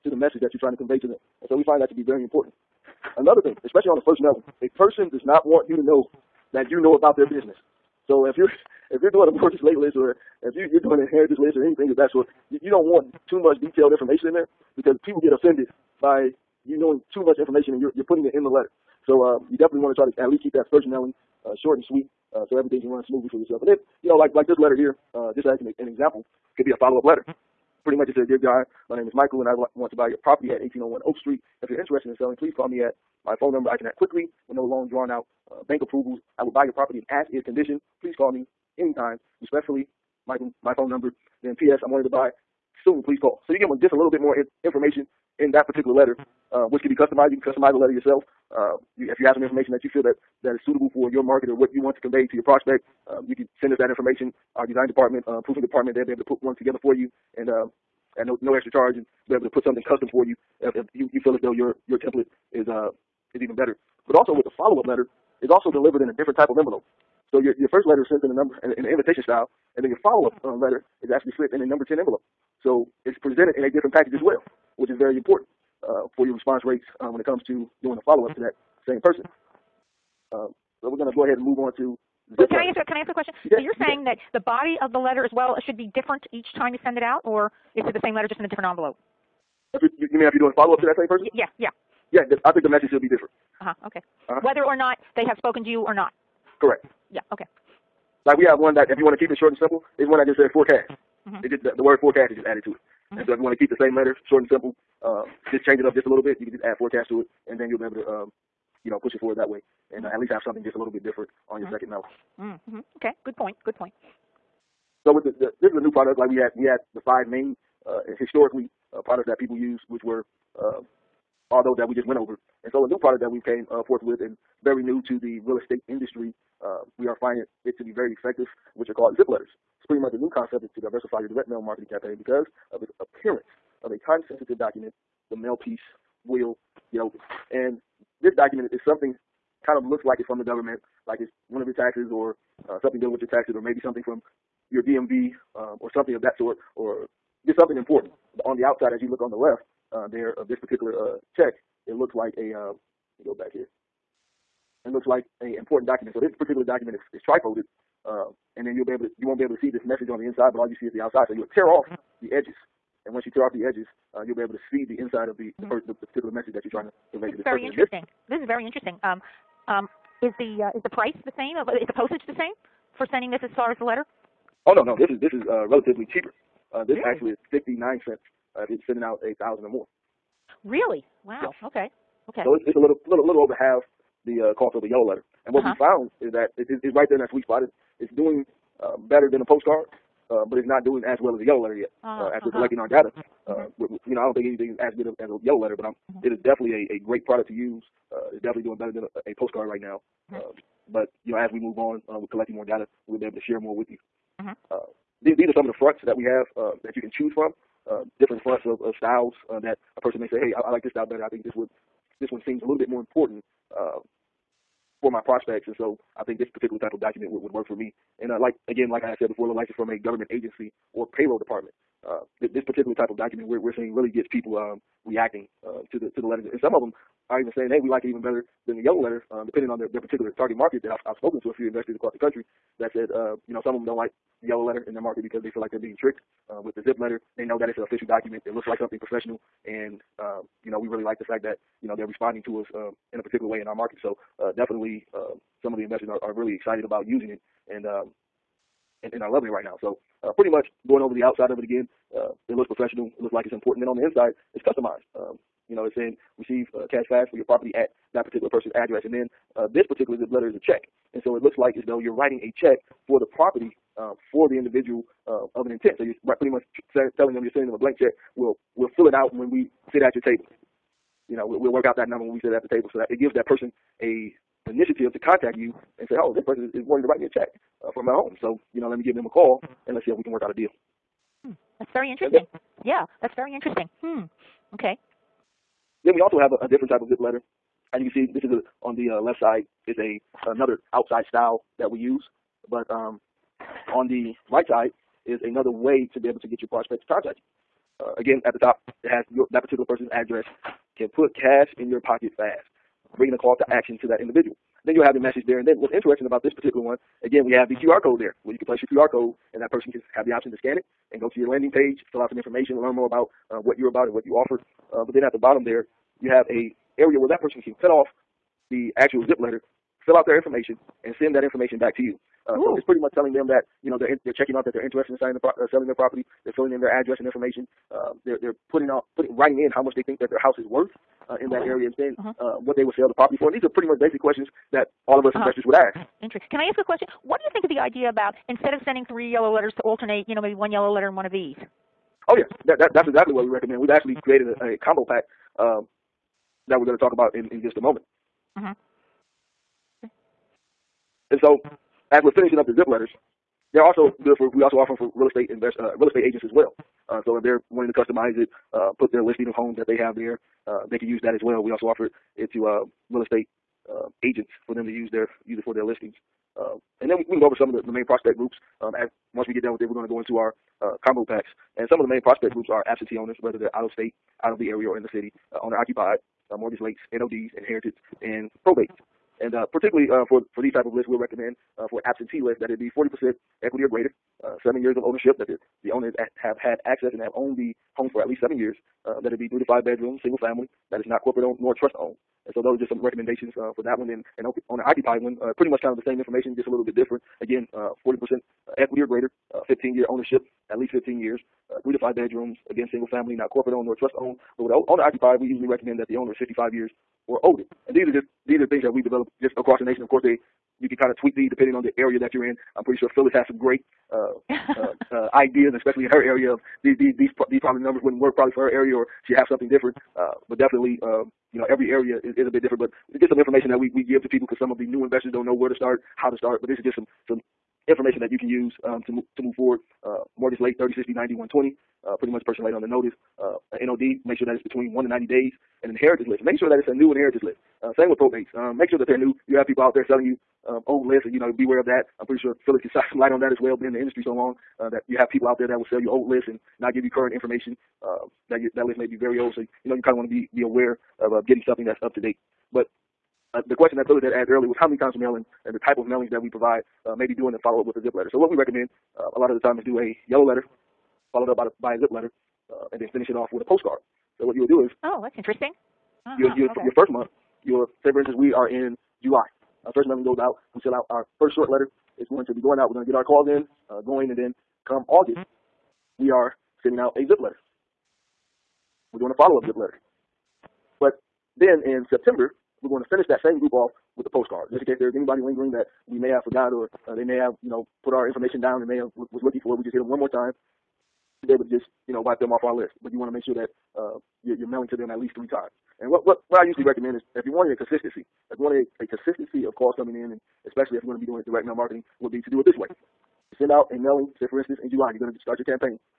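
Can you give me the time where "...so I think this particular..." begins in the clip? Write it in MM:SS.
03:35.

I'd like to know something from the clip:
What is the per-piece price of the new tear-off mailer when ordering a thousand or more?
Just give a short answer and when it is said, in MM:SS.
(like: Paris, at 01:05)
59 cents, at 02:57.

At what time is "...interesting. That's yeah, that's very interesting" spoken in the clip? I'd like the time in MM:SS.
04:42.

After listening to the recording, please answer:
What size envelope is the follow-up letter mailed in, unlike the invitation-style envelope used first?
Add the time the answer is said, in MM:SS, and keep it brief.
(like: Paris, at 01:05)
number 10, at 01:11.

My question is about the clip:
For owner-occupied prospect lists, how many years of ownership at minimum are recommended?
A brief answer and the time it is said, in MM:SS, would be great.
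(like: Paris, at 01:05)
15 years, at 06:39.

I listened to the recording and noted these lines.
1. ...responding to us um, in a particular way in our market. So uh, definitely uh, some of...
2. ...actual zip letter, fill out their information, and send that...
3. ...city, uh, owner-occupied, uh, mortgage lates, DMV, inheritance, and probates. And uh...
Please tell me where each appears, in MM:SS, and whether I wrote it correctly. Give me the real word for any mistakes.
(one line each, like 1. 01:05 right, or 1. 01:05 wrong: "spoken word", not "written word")
1. 04:02 right
2. 05:18 right
3. 06:15 wrong: "NODs", not "DMV".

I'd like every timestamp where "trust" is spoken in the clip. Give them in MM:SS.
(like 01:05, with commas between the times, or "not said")
06:31, 06:43.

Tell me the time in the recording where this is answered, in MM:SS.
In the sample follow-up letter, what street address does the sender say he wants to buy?
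00:30.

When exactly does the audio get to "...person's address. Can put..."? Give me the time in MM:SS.
04:59.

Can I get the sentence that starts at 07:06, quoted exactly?
But this is just some some information that you can use um, to to move forward.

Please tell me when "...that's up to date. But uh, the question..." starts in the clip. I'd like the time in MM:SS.
07:31.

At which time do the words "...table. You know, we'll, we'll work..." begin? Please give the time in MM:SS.
04:30.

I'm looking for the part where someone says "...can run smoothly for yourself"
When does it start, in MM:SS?
00:22.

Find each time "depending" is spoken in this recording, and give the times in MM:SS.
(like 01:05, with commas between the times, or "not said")
03:49, 06:51.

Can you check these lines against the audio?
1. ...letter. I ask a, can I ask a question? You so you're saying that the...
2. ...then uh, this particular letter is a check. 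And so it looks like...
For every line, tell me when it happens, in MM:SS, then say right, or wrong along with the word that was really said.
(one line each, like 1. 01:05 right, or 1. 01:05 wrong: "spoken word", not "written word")
1. 01:22 right
2. 04:19 right.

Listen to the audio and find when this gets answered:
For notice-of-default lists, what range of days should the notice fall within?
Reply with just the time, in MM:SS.
07:14.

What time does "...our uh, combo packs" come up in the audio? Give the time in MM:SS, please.
06:10.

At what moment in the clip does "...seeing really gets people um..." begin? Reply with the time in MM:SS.
03:43.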